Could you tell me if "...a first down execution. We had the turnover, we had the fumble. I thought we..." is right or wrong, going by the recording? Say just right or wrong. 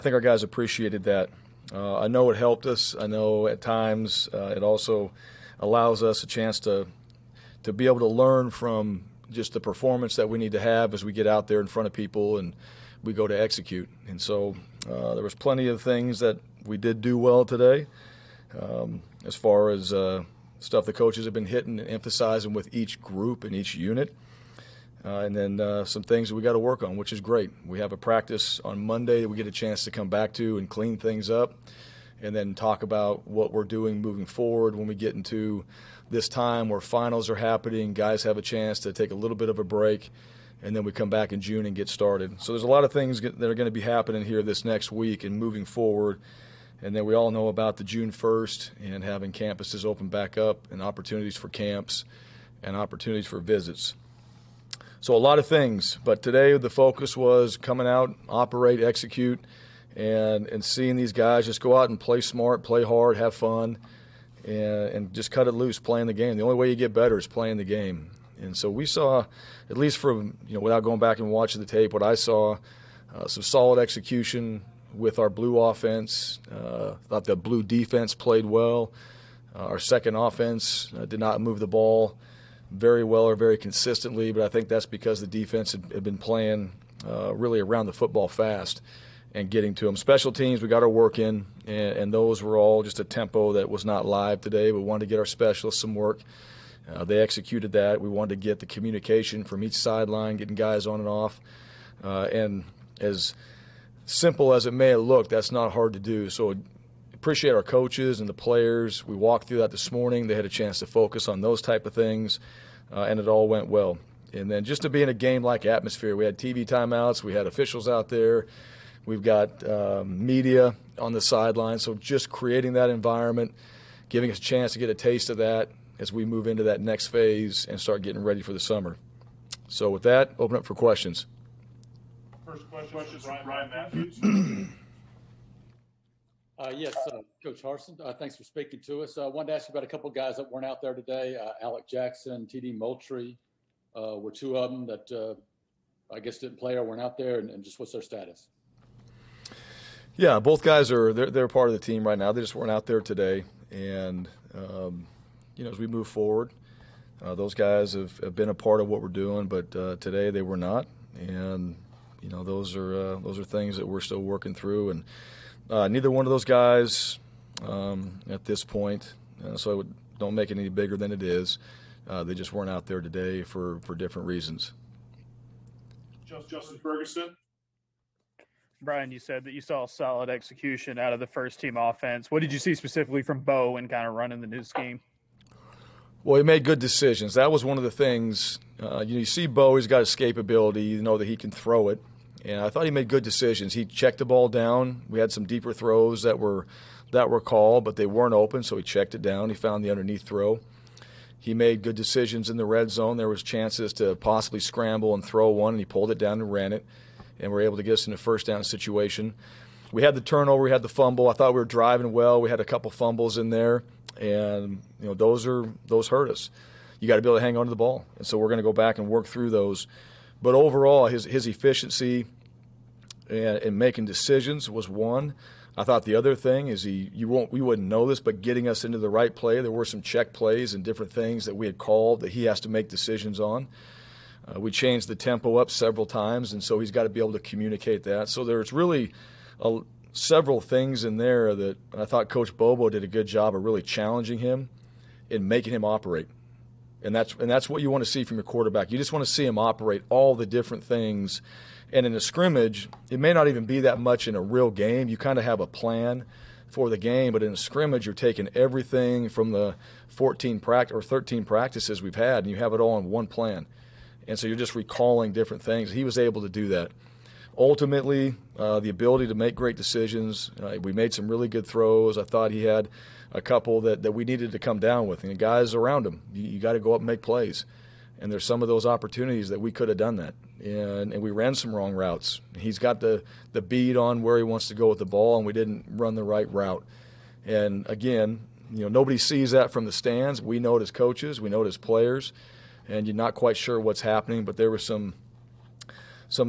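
wrong.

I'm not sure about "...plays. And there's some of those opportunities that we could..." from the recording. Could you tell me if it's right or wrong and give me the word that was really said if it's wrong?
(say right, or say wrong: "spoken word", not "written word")
right.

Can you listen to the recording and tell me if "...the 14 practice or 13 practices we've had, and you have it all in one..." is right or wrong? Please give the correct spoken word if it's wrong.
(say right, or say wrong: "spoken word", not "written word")
right.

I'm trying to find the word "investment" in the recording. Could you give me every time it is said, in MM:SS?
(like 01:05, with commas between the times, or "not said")
not said.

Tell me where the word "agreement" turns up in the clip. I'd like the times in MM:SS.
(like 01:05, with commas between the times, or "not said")
not said.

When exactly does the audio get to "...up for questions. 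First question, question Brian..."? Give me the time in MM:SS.
02:10.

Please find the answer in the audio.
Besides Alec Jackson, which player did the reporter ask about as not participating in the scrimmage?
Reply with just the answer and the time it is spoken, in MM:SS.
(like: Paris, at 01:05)
TD Moultrie, at 02:22.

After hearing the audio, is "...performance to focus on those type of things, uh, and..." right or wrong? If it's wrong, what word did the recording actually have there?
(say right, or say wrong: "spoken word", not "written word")
wrong: "chance", not "performance".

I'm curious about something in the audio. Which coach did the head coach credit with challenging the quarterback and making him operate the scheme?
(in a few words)
Coach Bobo.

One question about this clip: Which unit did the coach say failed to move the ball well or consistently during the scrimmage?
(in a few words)
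Second offense.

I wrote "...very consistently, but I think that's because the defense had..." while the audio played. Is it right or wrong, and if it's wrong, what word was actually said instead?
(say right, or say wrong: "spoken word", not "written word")
right.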